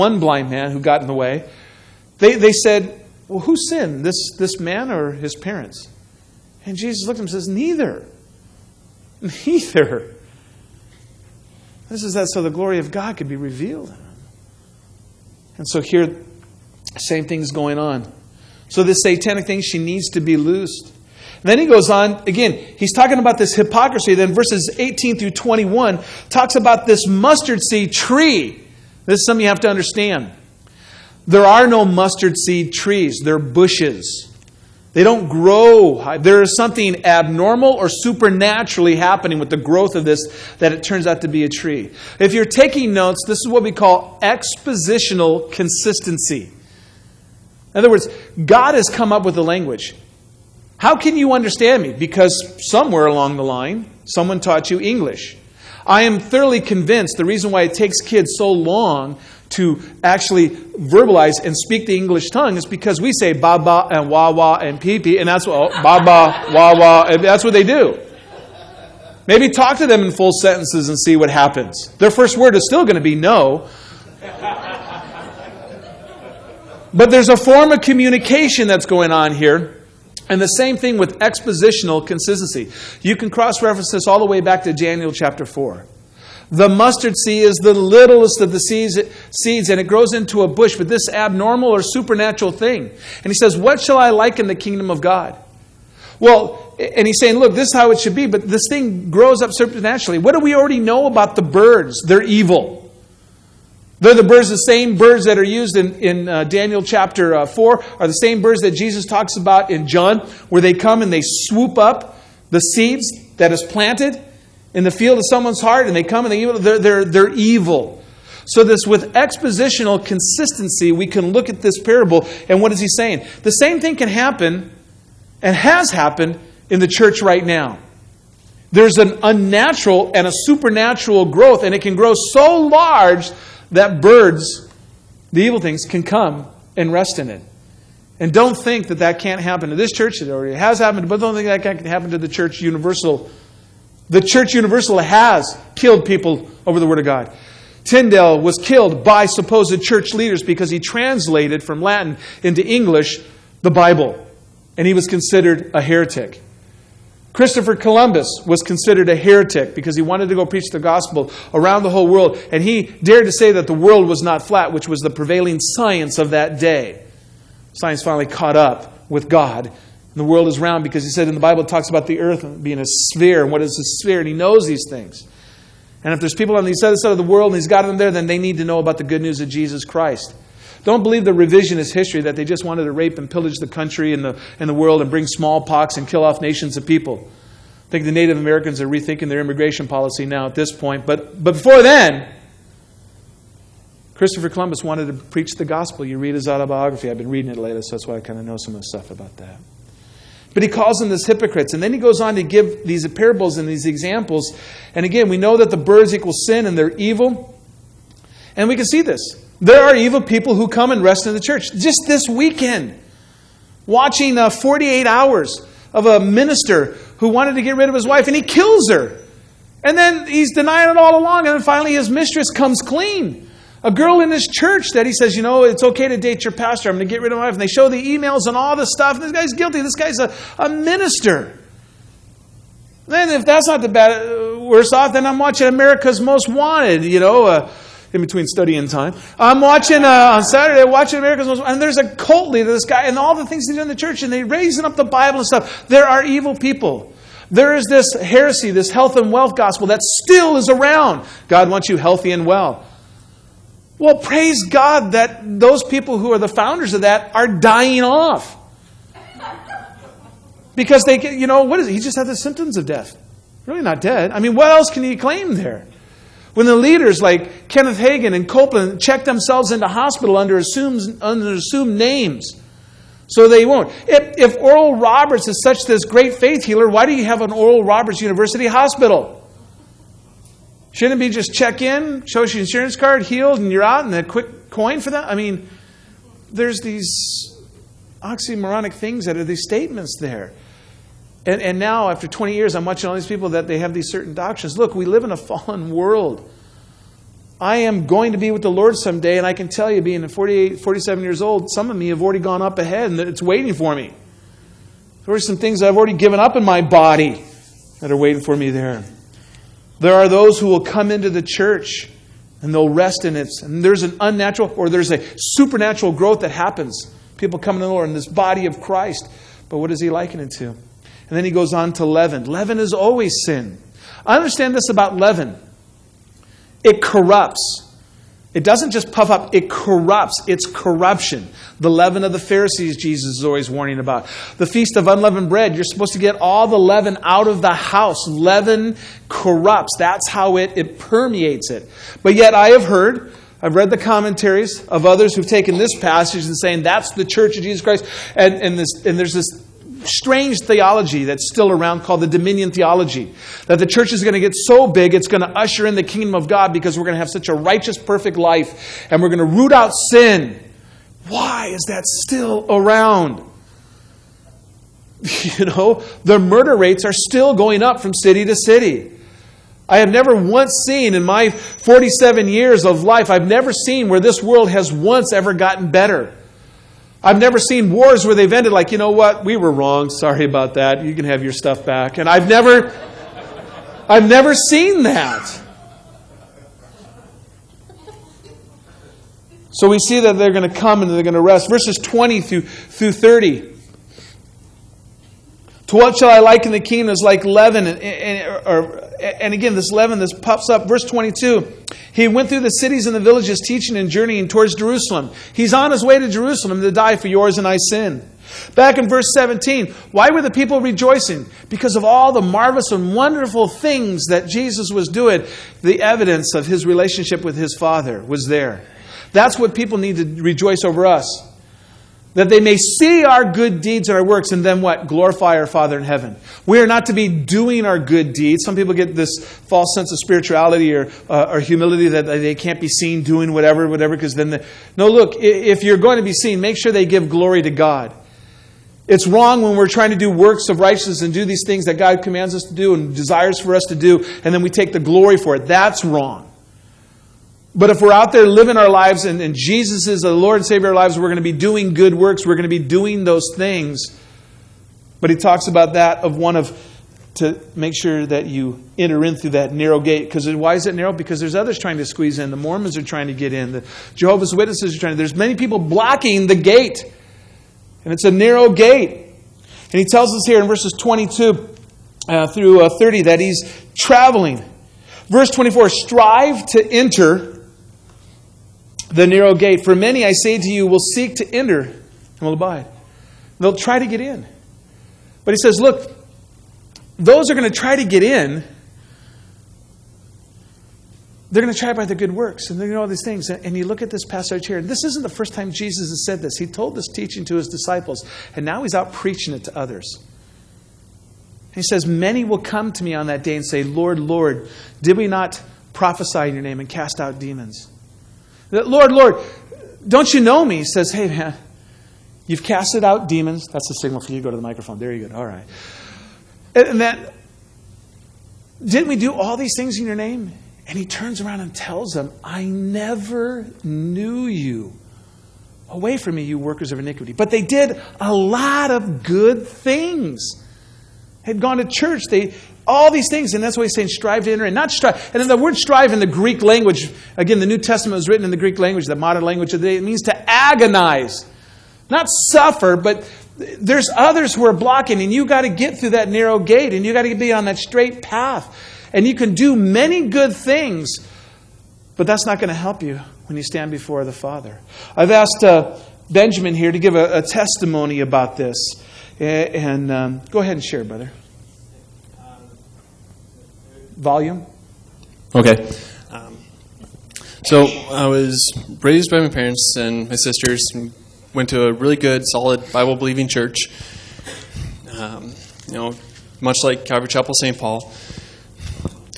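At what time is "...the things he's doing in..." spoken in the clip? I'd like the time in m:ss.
4:03.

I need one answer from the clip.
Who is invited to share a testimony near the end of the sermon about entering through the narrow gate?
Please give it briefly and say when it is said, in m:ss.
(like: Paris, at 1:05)
Benjamin, at 9:16.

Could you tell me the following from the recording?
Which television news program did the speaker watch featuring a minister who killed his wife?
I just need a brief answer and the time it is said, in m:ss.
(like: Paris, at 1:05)
48 Hours, at 3:34.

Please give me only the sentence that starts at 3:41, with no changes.
And then finally, his mistress comes clean.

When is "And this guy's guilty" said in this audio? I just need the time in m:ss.
3:49.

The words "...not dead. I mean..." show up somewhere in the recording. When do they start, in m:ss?
4:23.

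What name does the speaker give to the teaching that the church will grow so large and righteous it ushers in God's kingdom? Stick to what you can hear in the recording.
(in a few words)
Dominion theology.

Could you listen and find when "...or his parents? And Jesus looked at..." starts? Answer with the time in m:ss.
0:04.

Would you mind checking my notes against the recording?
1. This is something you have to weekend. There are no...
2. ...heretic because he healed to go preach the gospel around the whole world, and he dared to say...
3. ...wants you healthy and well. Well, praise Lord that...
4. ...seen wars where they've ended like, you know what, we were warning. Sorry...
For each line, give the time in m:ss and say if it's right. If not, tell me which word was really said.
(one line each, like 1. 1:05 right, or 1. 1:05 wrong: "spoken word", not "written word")
1. 0:29 wrong: "understand", not "weekend"
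2. 2:39 wrong: "wanted", not "healed"
3. 4:11 wrong: "God", not "Lord"
4. 6:17 wrong: "wrong", not "warning".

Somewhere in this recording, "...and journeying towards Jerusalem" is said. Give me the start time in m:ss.
6:43.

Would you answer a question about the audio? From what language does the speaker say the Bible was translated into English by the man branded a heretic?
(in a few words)
Latin.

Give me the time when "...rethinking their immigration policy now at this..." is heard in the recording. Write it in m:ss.
3:08.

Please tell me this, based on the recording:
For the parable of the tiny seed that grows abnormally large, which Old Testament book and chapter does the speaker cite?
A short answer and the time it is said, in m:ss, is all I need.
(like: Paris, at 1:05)
Daniel chapter 4, at 1:24.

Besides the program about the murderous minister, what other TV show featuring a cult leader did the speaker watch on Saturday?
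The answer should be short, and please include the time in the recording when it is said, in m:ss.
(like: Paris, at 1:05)
America's Most Wanted, at 3:55.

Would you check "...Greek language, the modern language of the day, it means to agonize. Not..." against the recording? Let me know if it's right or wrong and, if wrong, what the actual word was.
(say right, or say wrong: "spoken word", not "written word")
right.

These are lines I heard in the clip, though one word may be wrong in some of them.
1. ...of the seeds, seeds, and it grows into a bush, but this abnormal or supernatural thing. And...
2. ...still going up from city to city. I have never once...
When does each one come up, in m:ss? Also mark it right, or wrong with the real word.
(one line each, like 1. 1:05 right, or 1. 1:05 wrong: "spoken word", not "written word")
1. 1:28 right
2. 6:07 right.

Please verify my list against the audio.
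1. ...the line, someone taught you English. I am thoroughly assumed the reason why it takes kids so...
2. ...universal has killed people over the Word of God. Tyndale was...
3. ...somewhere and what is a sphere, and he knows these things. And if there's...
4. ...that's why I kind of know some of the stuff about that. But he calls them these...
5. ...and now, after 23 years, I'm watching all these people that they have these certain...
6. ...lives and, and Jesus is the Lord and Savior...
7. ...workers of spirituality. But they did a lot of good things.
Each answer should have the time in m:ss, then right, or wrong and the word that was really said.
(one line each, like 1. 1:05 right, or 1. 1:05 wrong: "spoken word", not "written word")
1. 0:53 wrong: "convinced", not "assumed"
2. 2:24 right
3. 2:52 wrong: "sphere", not "somewhere"
4. 3:17 right
5. 4:51 wrong: "20", not "23"
6. 7:28 right
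7. 8:46 wrong: "iniquity", not "spirituality".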